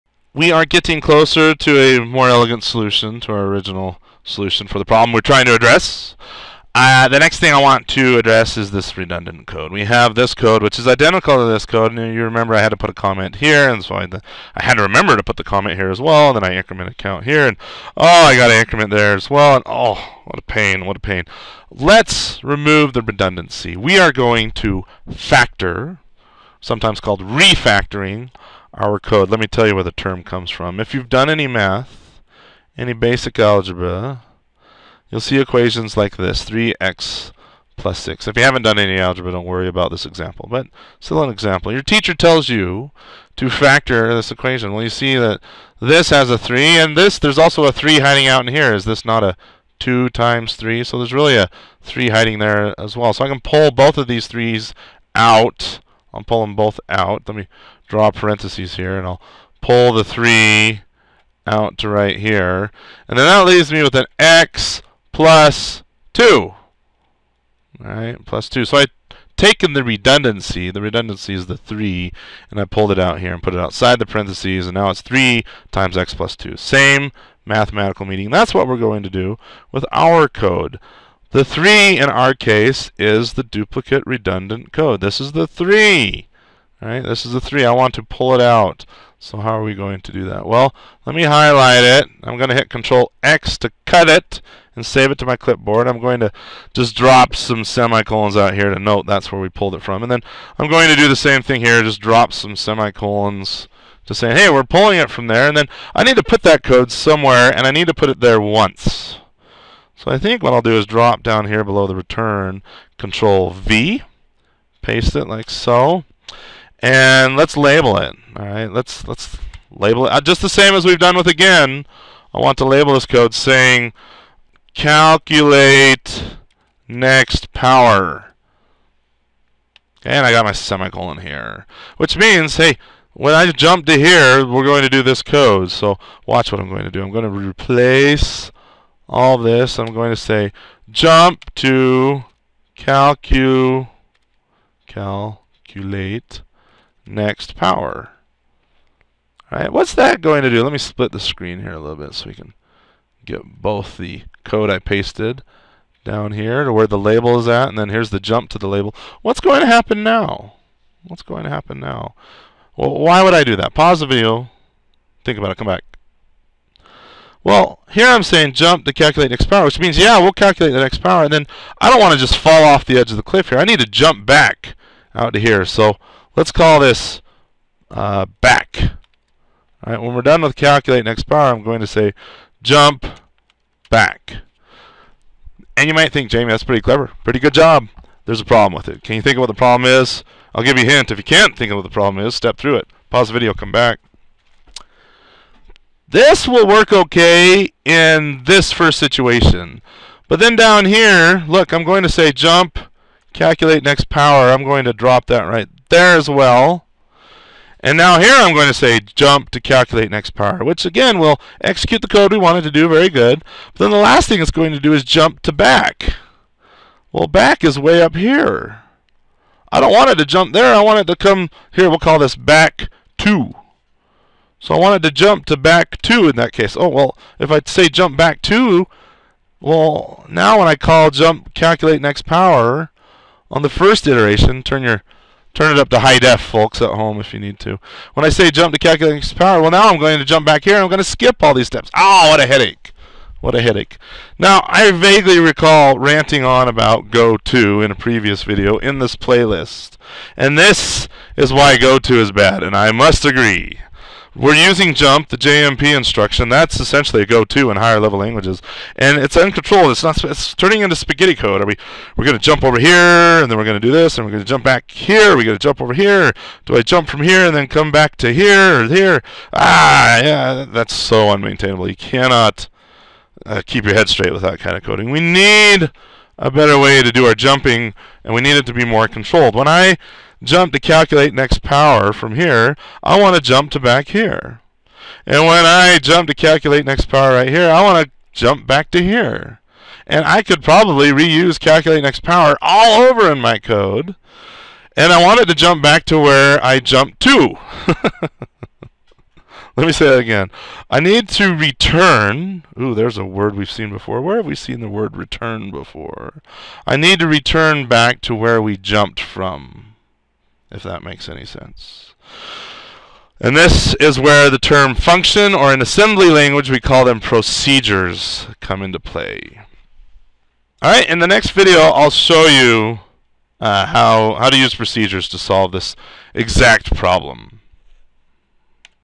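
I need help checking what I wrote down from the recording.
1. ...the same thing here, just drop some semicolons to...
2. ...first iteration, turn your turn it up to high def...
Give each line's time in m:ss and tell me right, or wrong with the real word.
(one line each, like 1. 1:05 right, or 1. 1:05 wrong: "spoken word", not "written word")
1. 1:41 right
2. 3:53 right.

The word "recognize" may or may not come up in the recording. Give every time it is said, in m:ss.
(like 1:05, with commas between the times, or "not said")
not said.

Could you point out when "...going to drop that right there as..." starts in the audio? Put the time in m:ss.
3:24.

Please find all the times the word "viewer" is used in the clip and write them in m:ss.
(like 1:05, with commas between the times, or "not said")
not said.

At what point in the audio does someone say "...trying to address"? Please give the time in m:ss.
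0:05.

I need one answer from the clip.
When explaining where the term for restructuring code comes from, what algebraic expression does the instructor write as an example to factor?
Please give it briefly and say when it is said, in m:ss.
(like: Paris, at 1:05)
3x + 6, at 0:36.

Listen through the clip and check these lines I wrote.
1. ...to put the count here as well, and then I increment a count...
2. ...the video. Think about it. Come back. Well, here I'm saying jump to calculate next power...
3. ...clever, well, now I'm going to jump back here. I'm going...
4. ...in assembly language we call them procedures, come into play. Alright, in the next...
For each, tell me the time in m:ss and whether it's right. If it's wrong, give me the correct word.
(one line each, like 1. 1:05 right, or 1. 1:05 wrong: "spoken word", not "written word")
1. 0:15 wrong: "comment", not "count"
2. 2:44 right
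3. 3:59 wrong: "power", not "clever"
4. 5:15 right.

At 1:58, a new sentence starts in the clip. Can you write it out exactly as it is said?
All right, let's let's label it uh, just the same as we've done with again.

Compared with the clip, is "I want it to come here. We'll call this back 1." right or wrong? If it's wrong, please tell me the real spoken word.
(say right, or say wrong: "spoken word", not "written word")
wrong: "2", not "1".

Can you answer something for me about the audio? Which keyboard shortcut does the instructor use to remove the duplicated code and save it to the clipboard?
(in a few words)
Control X.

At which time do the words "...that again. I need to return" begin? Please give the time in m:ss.
5:00.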